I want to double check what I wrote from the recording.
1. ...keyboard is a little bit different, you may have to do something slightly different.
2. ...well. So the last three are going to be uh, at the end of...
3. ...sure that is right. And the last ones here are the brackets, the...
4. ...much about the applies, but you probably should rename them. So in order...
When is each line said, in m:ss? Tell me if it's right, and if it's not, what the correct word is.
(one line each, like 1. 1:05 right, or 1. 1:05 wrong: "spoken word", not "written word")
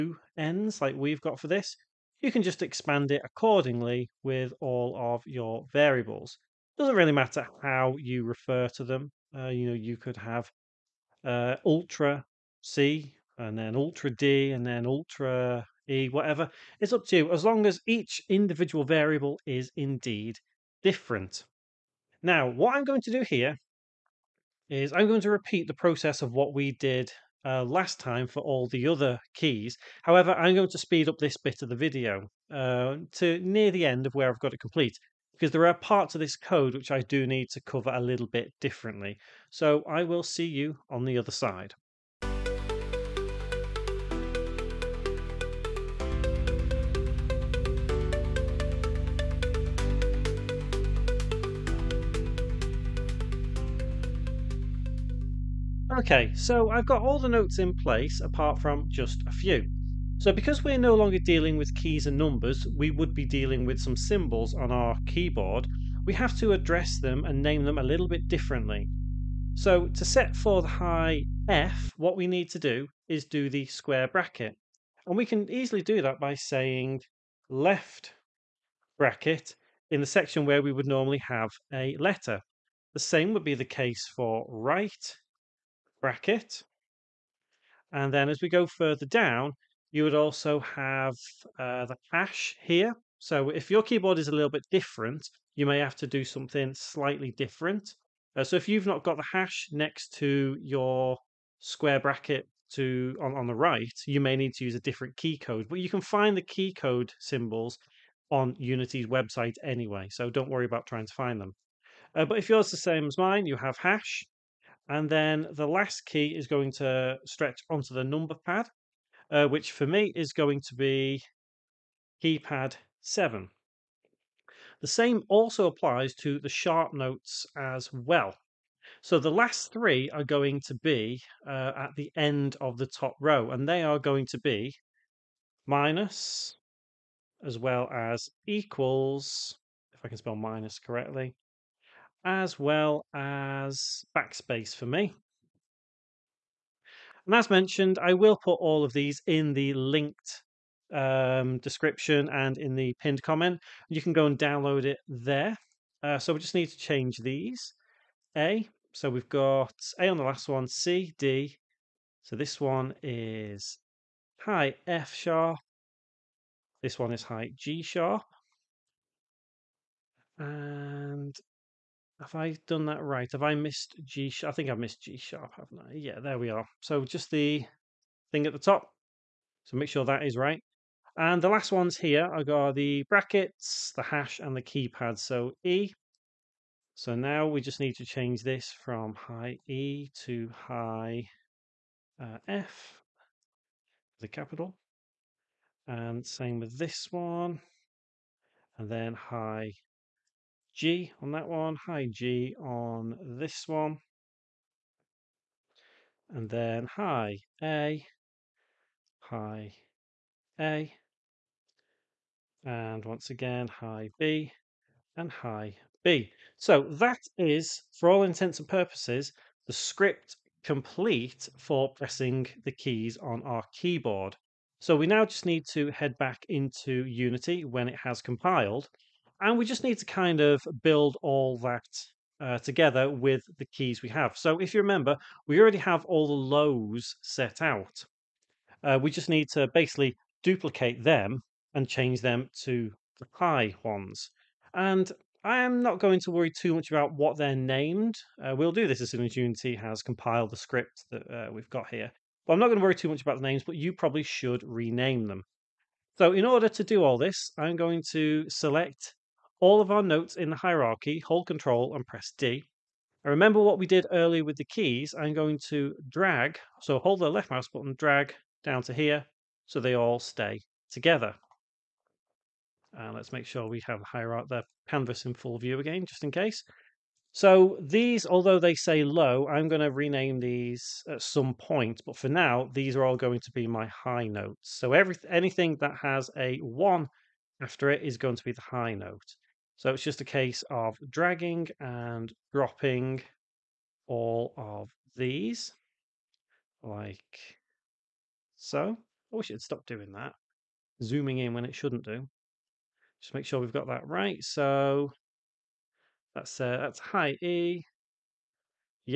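1. 1:33 right
2. 2:07 right
3. 2:59 right
4. 4:13 wrong: "names", not "applies".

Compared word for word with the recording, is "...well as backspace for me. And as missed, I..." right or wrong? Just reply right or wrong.
wrong.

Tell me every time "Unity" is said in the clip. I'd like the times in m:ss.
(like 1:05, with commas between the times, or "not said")
1:48, 3:47, 4:09.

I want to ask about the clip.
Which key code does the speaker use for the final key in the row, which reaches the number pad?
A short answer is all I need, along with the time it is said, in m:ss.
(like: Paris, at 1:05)
keypad 7, at 2:02.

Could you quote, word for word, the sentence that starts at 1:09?
So to set for the high F, what we need to do is do the square bracket.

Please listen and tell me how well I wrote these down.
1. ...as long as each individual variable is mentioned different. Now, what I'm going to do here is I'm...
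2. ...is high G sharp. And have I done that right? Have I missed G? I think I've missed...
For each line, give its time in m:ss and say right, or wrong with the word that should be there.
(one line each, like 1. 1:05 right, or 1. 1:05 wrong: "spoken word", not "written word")
1. 0:17 wrong: "indeed", not "mentioned"
2. 2:47 right.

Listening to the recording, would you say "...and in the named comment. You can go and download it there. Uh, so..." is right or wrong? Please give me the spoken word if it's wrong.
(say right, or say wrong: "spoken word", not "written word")
wrong: "pinned", not "named".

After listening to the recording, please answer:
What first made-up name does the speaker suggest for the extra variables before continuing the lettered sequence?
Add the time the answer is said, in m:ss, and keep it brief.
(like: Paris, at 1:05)
Ultra C, at 0:11.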